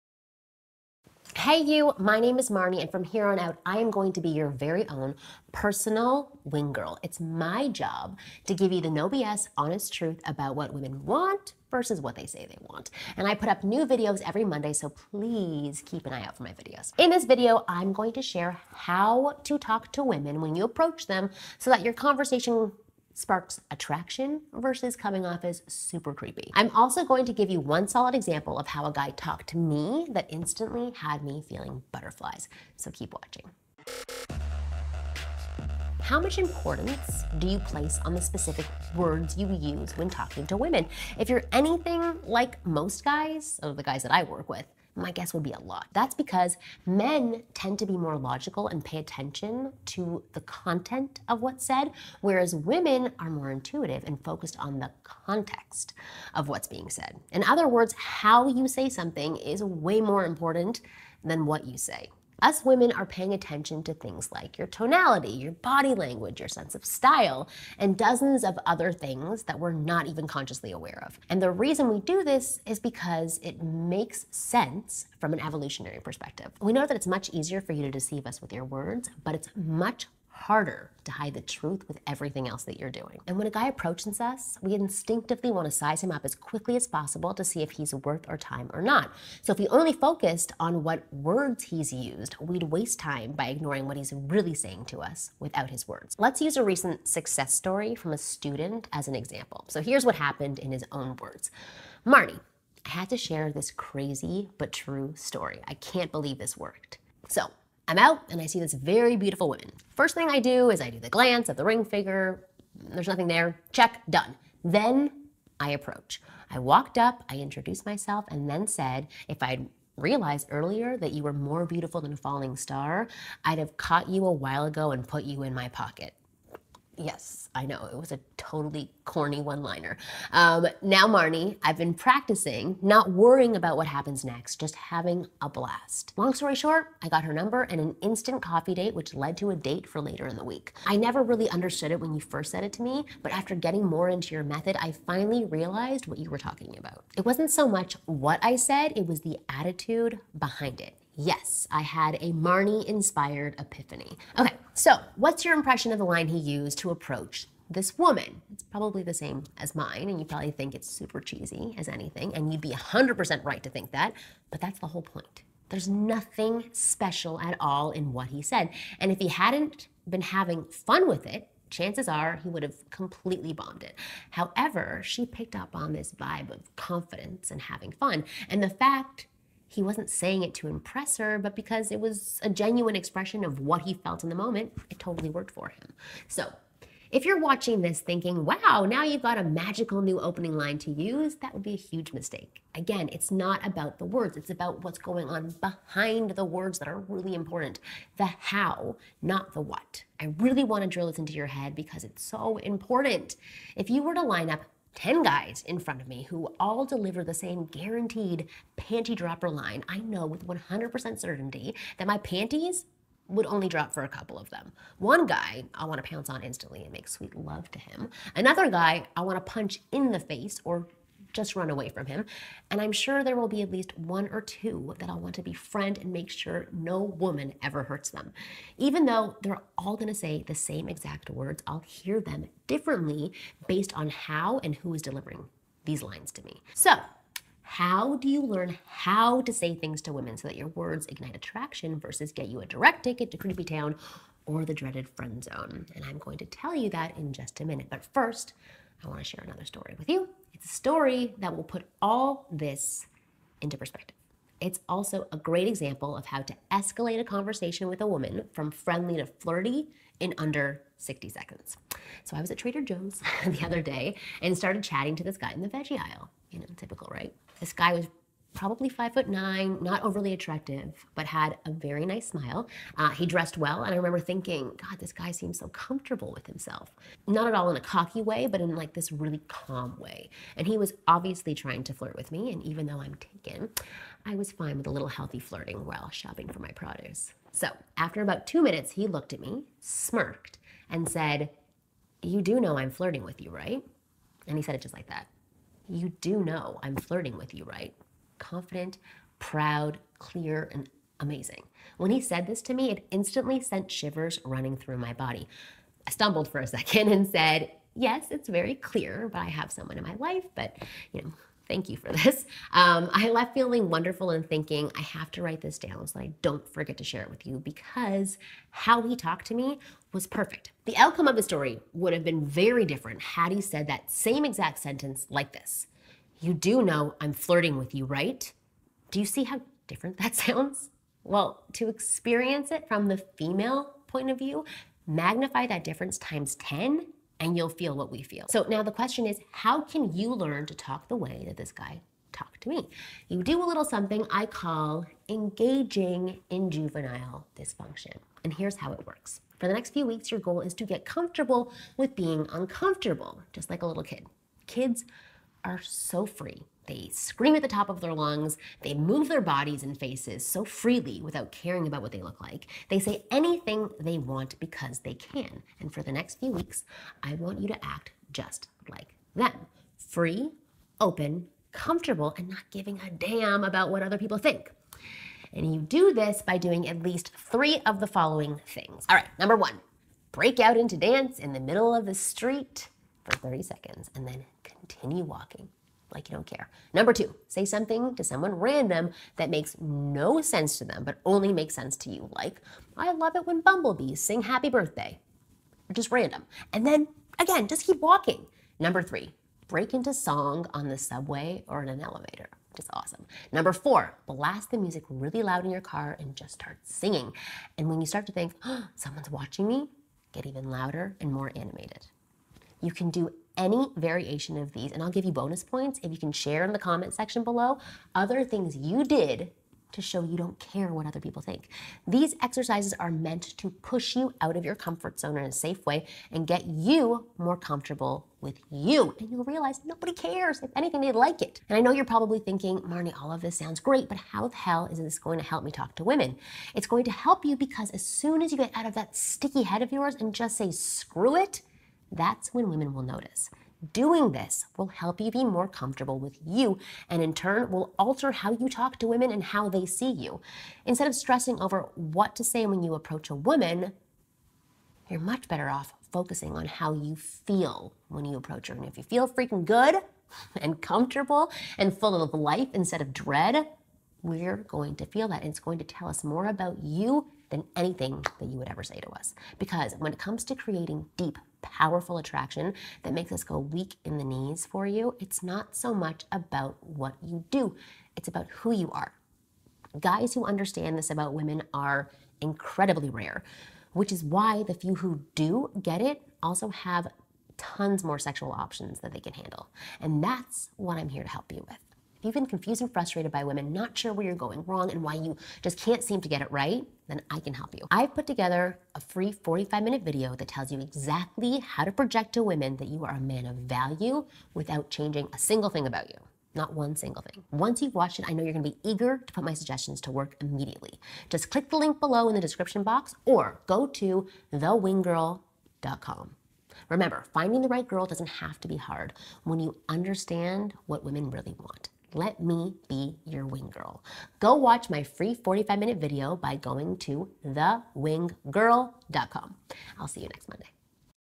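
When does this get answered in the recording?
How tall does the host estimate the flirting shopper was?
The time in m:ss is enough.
4:28.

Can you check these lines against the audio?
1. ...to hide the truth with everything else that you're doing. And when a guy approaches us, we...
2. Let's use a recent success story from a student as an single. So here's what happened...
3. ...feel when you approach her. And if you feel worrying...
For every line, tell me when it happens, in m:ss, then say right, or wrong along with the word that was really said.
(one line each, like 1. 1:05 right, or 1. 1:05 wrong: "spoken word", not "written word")
1. 1:21 right
2. 1:36 wrong: "example", not "single"
3. 7:37 wrong: "freaking", not "worrying".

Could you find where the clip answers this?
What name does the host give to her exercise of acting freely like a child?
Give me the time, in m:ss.
5:46.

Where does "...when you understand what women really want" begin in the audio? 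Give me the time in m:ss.
8:39.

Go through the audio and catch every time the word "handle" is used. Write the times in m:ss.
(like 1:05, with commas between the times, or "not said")
8:09.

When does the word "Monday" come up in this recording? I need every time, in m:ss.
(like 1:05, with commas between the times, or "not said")
0:14, 8:50.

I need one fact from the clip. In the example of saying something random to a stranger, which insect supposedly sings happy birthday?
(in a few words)
bumblebees.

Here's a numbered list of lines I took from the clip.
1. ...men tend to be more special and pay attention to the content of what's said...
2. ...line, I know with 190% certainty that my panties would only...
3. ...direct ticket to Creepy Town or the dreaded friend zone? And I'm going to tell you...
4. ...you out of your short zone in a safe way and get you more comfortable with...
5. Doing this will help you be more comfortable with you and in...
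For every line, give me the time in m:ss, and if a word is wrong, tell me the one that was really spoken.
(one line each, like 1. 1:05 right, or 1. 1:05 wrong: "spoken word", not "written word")
1. 0:46 wrong: "logical", not "special"
2. 3:29 wrong: "100", not "190"
3. 4:02 right
4. 7:04 wrong: "comfort", not "short"
5. 7:23 right.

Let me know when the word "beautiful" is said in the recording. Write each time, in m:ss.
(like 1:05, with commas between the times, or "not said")
1:49, 2:01.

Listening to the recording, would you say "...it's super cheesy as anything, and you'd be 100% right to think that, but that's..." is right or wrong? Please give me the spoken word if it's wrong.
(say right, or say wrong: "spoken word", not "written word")
right.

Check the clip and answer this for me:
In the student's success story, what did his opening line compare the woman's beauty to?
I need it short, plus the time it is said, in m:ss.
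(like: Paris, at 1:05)
a falling star, at 2:02.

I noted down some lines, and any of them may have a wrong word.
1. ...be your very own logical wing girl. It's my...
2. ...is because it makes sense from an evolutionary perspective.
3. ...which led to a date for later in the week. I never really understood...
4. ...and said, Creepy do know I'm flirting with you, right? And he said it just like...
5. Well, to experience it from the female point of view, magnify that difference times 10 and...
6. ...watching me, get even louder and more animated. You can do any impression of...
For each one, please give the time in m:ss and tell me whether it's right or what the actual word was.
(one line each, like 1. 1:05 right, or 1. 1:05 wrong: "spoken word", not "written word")
1. 0:04 wrong: "personal", not "logical"
2. 1:12 right
3. 2:18 right
4. 4:50 wrong: "You", not "Creepy"
5. 5:31 right
6. 6:49 wrong: "variation", not "impression".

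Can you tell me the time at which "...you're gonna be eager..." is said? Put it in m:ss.
8:28.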